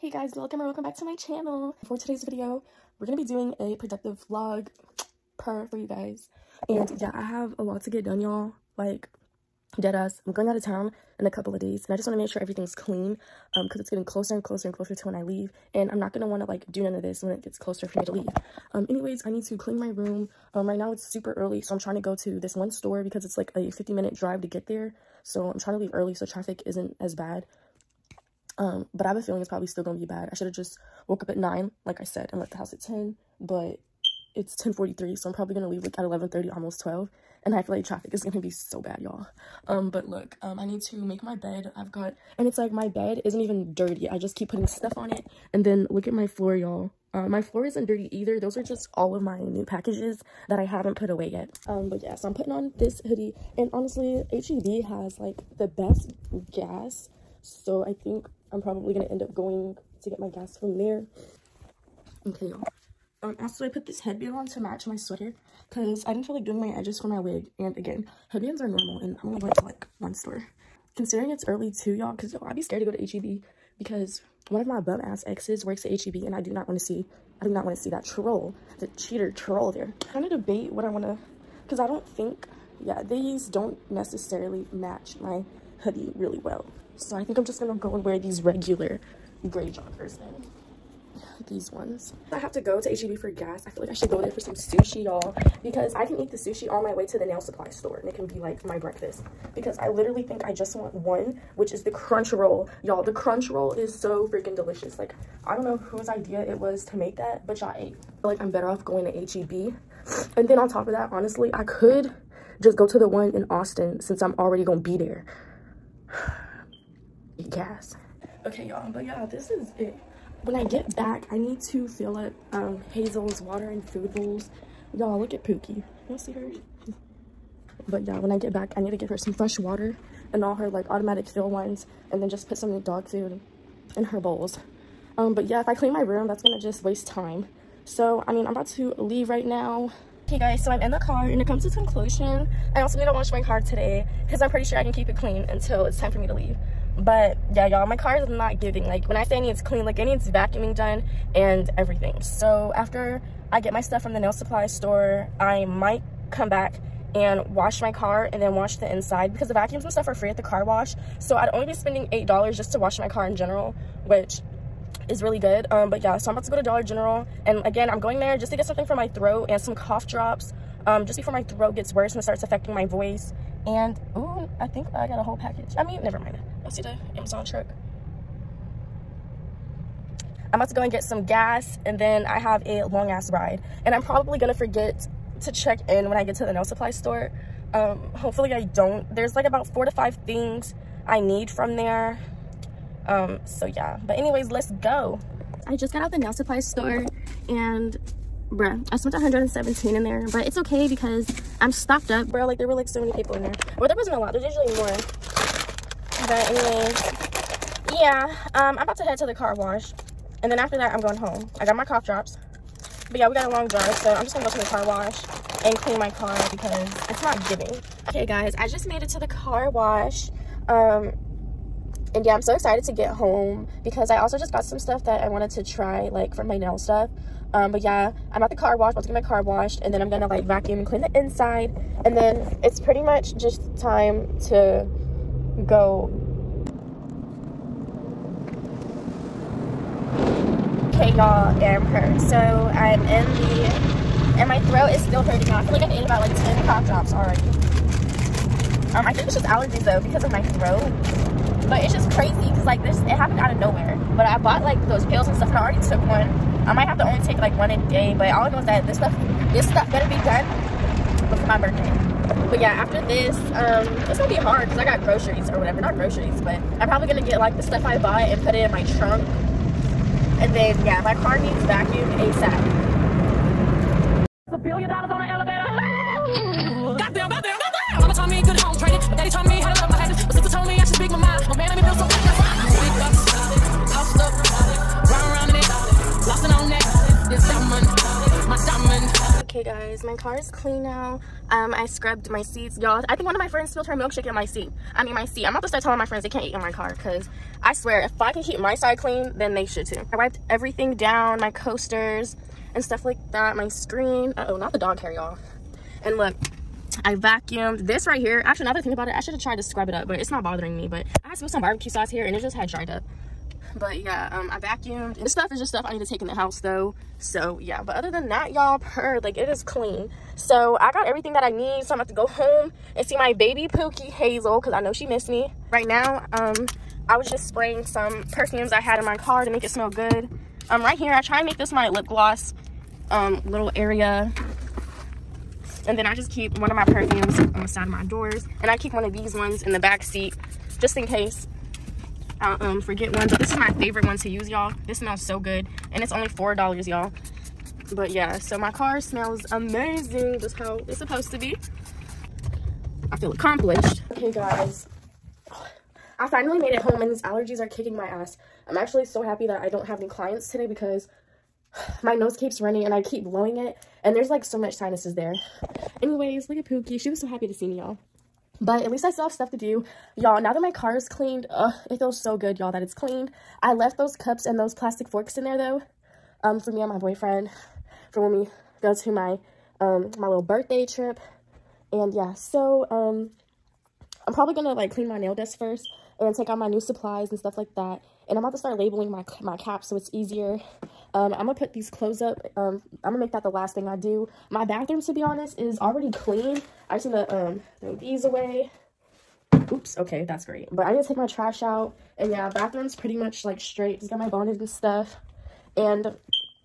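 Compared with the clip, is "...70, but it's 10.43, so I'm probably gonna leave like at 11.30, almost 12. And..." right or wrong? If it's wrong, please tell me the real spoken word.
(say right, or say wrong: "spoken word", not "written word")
wrong: "10", not "70".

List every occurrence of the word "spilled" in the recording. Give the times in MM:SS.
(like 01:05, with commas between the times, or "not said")
04:53, 05:11.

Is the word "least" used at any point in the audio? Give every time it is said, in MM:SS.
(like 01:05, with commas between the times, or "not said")
06:08.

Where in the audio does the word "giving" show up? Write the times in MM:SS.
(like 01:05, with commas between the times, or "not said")
02:28, 03:37.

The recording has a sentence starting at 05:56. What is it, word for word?
I finally made it home and these allergies are kicking my ass.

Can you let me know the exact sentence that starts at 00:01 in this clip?
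For today's video, we're gonna be doing a productive vlog per for you guys.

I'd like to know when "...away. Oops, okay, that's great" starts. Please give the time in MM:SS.
06:38.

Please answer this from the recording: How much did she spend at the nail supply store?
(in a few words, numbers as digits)
117.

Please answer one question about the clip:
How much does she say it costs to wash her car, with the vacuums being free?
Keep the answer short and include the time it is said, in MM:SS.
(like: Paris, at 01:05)
$8, at 02:42.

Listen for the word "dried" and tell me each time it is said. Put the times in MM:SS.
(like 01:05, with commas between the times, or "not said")
05:12.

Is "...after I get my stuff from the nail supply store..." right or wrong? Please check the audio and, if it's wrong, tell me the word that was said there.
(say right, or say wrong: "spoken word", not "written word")
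right.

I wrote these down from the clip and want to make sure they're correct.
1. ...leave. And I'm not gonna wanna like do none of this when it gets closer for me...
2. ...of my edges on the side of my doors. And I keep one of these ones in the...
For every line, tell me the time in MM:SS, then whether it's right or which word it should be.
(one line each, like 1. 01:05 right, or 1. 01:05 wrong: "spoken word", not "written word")
1. 00:15 right
2. 05:36 wrong: "perfumes", not "edges".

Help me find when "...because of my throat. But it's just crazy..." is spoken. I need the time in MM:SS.
04:10.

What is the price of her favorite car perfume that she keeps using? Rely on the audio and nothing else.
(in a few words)
$4.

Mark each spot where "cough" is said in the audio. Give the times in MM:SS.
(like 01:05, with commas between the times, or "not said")
02:49, 03:31, 04:06.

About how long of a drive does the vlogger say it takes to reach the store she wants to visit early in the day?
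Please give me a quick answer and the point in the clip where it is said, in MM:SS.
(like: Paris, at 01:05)
50 minutes, at 00:23.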